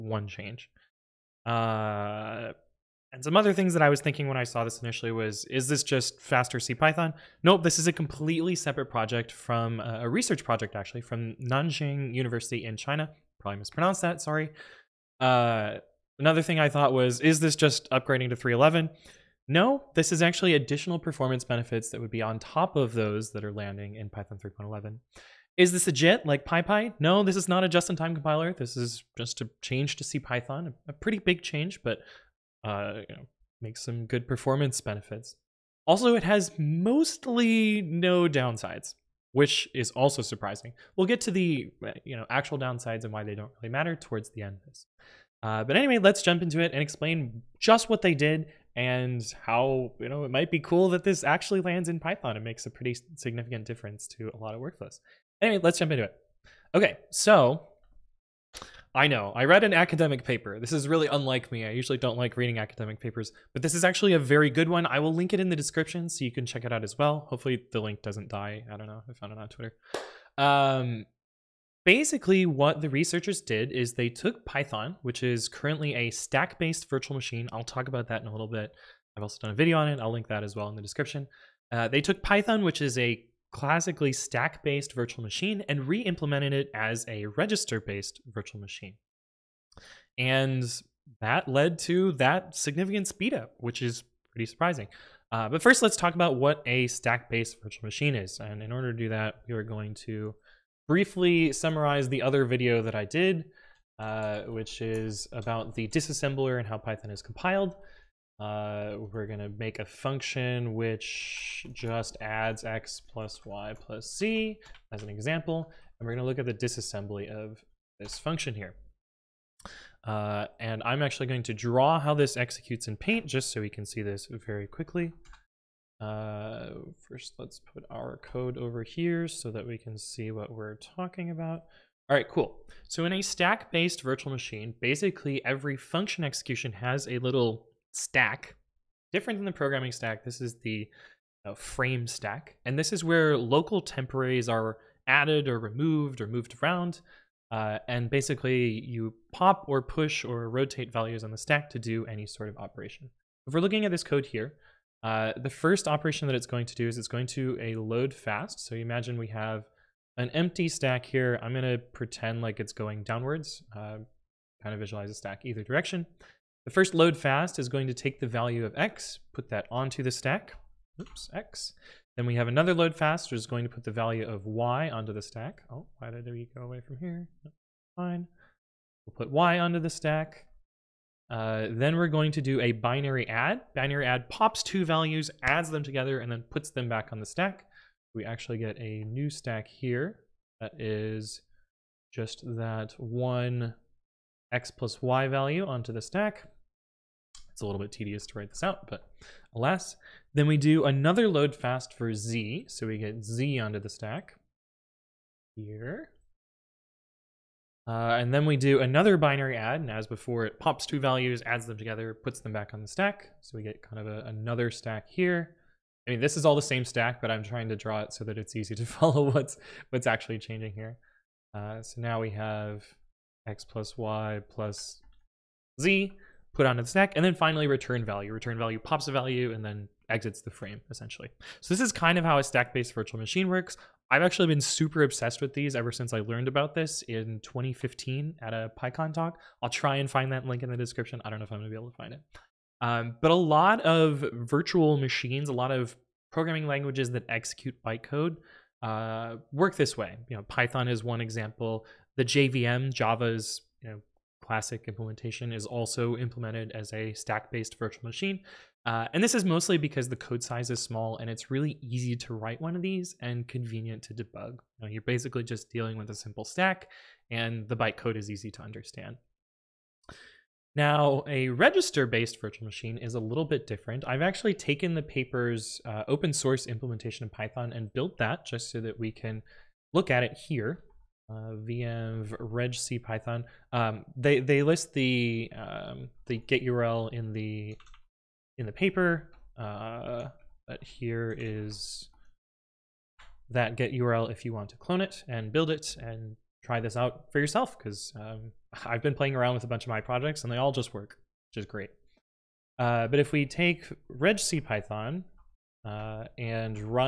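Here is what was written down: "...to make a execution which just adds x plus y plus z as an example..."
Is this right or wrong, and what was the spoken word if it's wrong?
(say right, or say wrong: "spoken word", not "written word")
wrong: "function", not "execution".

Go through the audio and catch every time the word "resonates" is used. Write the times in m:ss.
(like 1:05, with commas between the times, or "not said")
not said.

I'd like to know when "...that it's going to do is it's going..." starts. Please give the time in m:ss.
2:36.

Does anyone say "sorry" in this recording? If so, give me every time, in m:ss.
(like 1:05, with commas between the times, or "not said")
0:14.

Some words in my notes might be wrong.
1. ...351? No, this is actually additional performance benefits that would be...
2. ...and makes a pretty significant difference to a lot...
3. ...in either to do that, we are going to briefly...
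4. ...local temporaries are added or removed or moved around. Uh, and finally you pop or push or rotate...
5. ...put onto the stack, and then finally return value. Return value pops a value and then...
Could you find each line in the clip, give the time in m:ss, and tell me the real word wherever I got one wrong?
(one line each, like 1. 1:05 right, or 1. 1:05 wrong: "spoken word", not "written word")
1. 0:18 wrong: "311", not "351"
2. 0:52 right
3. 1:38 wrong: "order", not "either"
4. 2:23 wrong: "basically", not "finally"
5. 3:46 right.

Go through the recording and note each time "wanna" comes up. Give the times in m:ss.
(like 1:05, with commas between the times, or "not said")
not said.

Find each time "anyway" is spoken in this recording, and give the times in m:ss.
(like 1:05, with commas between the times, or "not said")
0:45, 0:55.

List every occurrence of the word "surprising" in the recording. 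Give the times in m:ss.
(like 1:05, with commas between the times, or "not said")
0:40, 1:34.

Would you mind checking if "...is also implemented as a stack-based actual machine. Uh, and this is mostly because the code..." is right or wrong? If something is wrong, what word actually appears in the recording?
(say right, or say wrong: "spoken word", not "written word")
wrong: "virtual", not "actual".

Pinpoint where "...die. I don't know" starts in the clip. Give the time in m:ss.
1:08.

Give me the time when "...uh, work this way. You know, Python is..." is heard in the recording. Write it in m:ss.
4:08.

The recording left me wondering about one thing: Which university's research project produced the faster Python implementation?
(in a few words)
Nanjing University.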